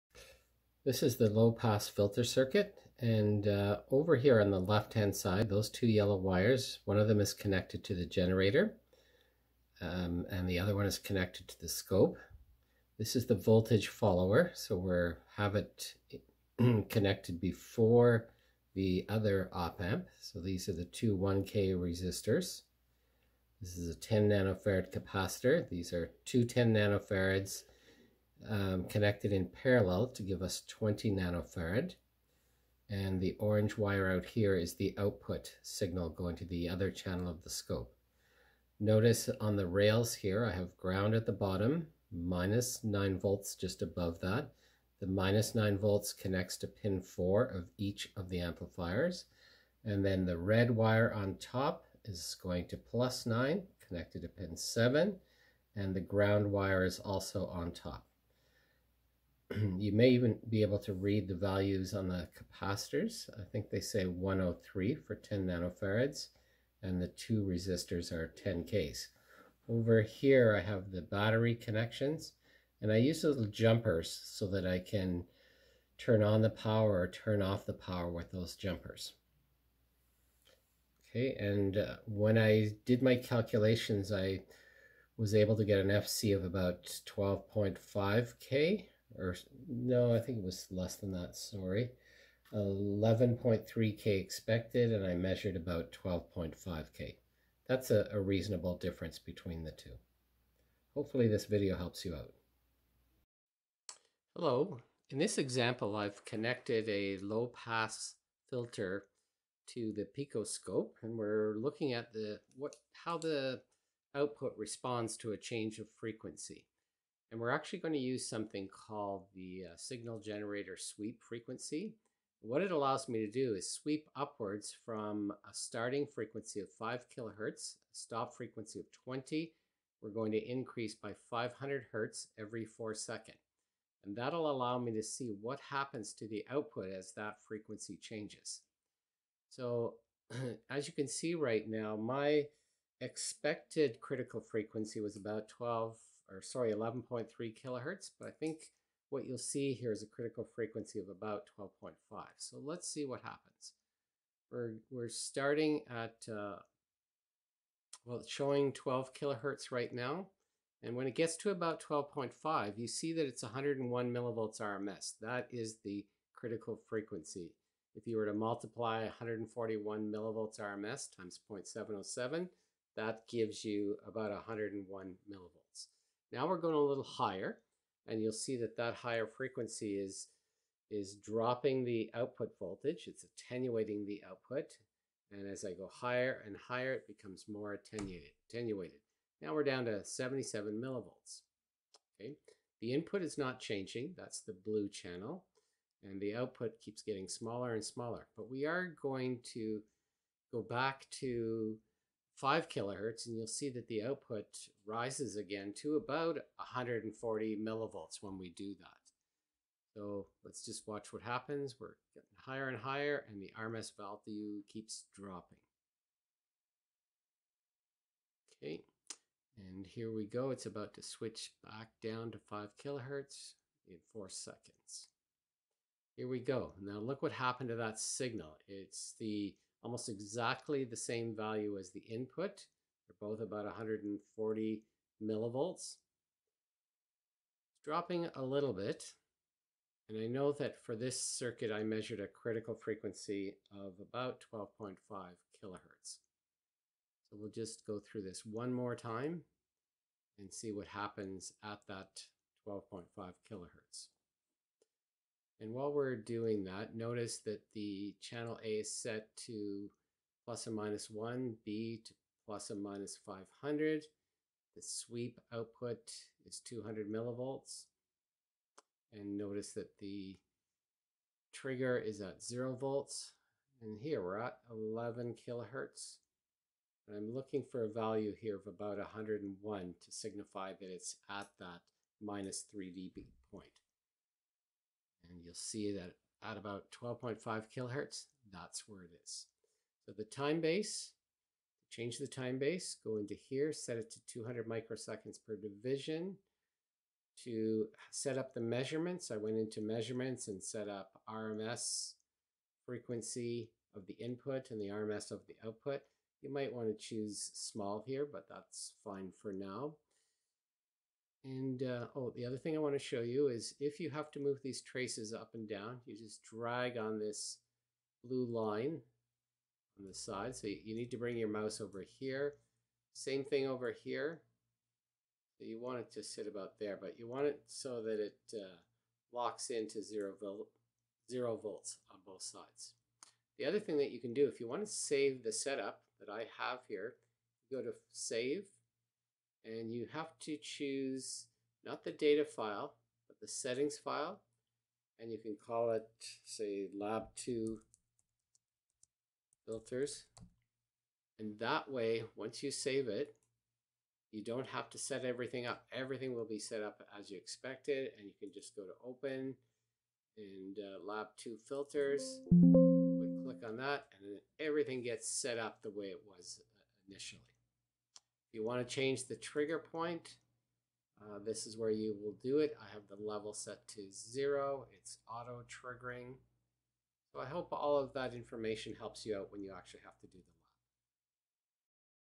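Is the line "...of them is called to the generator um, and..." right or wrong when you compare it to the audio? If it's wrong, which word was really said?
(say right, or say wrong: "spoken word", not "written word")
wrong: "connected", not "called".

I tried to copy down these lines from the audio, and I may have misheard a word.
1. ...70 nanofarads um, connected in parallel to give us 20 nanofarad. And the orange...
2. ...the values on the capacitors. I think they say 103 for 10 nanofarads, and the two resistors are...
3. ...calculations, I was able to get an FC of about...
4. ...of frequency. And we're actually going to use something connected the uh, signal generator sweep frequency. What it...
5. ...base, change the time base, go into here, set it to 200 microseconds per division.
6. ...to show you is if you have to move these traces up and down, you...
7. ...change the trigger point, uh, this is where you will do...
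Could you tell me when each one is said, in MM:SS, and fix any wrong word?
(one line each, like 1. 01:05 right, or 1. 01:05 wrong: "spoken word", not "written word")
1. 00:26 wrong: "10", not "70"
2. 01:01 right
3. 01:23 right
4. 01:55 wrong: "called", not "connected"
5. 04:50 right
6. 05:12 right
7. 06:08 right.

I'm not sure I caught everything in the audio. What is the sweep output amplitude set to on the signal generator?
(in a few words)
200 millivolts.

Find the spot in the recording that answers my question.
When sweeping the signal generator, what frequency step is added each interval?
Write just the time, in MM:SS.
02:11.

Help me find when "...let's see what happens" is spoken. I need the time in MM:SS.
02:32.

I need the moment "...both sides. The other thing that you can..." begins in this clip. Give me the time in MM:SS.
05:32.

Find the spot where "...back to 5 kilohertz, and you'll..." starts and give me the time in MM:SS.
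03:20.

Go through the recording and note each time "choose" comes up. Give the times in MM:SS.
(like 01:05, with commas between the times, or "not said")
05:06, 05:40.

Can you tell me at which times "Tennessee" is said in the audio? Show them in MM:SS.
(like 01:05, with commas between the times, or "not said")
not said.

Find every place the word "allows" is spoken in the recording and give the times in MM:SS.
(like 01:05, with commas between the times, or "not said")
02:02, 02:14.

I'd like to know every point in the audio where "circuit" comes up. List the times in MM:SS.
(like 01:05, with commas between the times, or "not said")
00:02, 04:01.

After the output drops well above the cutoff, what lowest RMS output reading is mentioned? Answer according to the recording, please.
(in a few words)
77 millivolts.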